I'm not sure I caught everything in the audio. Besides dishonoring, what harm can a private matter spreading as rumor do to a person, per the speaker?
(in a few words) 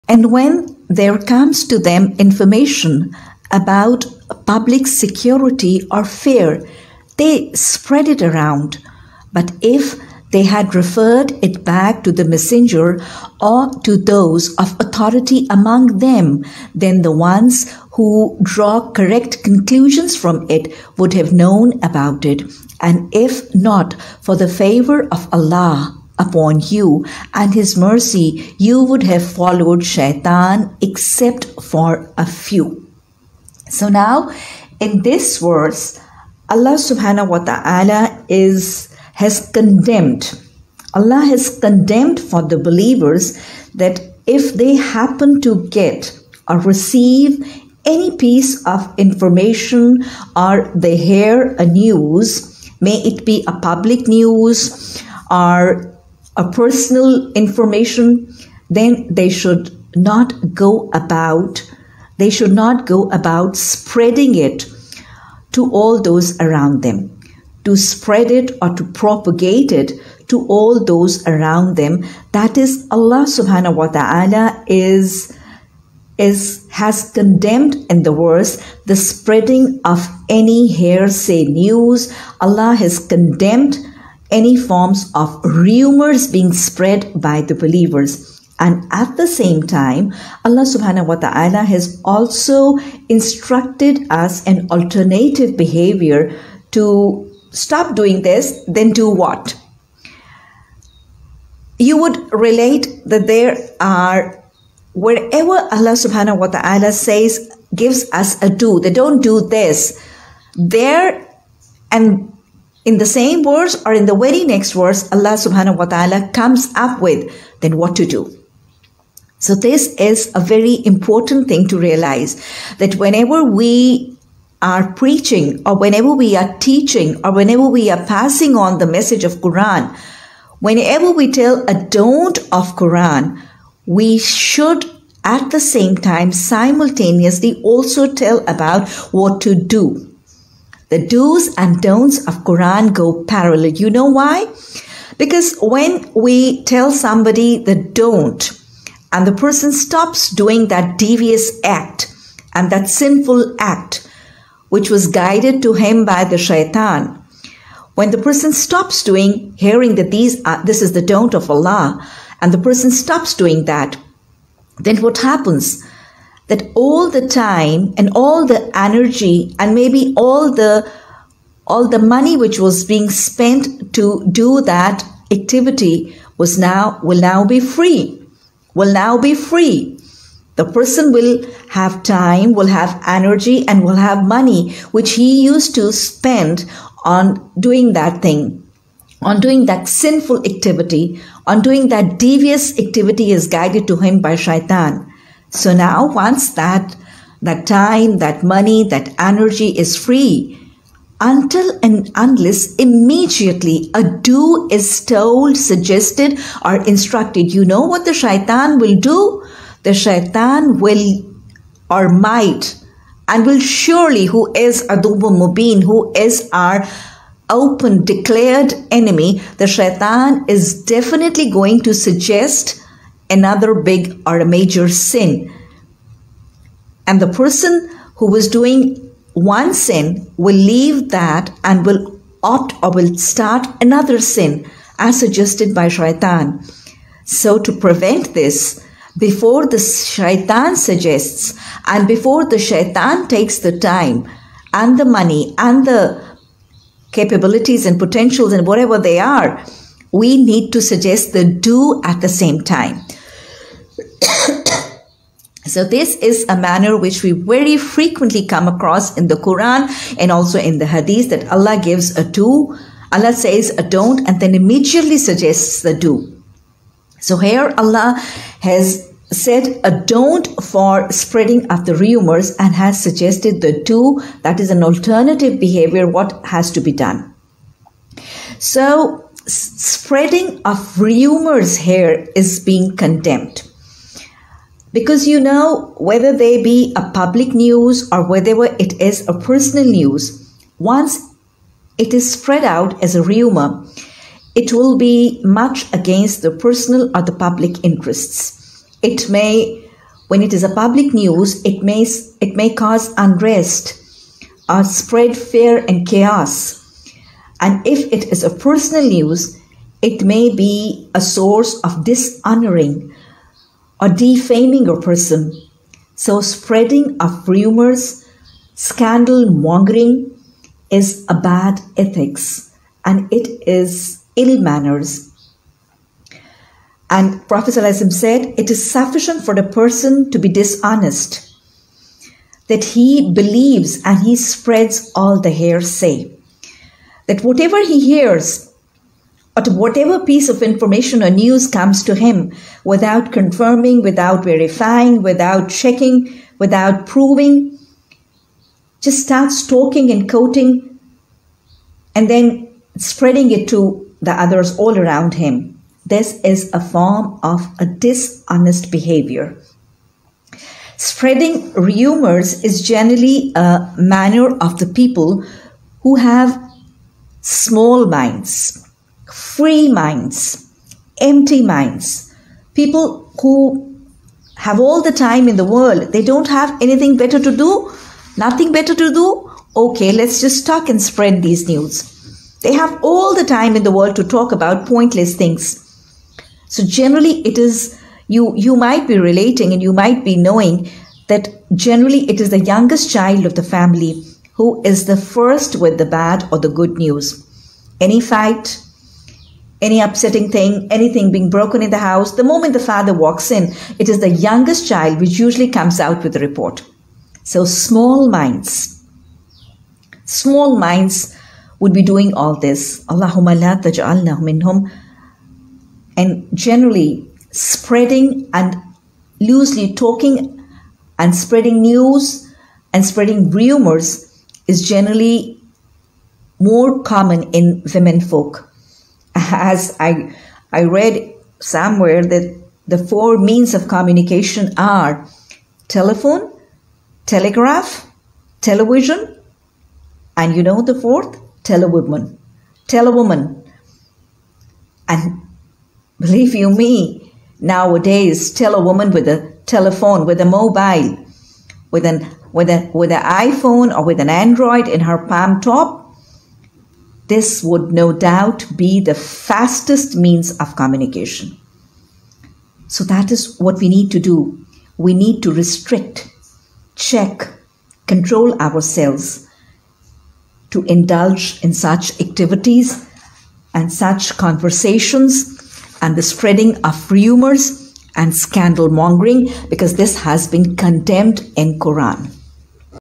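defaming.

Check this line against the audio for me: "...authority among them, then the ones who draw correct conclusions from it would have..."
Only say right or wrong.
right.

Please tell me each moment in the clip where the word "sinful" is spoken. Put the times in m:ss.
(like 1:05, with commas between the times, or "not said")
2:32, 3:09.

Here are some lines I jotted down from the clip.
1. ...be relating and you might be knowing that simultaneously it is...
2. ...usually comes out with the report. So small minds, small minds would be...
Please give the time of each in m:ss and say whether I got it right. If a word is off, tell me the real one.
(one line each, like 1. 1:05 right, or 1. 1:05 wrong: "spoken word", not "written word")
1. 6:29 wrong: "generally", not "simultaneously"
2. 6:45 right.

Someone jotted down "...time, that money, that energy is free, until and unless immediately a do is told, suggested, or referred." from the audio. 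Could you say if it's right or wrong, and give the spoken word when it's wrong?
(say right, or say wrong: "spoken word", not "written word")
wrong: "instructed", not "referred".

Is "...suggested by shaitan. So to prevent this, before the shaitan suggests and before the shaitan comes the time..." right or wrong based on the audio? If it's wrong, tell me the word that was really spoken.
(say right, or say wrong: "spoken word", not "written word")
wrong: "takes", not "comes".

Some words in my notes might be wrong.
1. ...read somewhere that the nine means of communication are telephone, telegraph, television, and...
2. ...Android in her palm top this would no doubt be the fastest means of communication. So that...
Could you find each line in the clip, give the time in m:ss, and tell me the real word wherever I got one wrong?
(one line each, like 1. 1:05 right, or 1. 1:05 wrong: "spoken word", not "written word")
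1. 7:10 wrong: "four", not "nine"
2. 7:34 right.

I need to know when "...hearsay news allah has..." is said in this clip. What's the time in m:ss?
1:20.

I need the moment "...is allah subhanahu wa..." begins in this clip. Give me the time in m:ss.
1:12.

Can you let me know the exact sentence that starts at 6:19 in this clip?
Okay, let's just talk and spread these news.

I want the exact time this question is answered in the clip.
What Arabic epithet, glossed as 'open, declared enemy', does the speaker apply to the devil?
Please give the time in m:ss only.
3:34.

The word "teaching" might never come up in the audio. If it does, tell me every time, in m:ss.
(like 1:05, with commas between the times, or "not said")
2:06.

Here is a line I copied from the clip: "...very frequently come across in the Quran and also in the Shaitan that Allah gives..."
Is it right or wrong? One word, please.
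wrong.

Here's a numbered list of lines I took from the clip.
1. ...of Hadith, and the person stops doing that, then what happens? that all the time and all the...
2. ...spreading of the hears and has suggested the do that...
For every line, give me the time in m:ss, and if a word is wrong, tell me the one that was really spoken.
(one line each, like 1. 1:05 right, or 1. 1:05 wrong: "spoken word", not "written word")
1. 2:41 wrong: "Allah", not "Hadith"
2. 4:31 wrong: "rumors", not "hears".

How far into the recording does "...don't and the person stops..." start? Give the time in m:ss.
2:27.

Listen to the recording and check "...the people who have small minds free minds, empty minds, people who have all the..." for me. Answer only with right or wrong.
right.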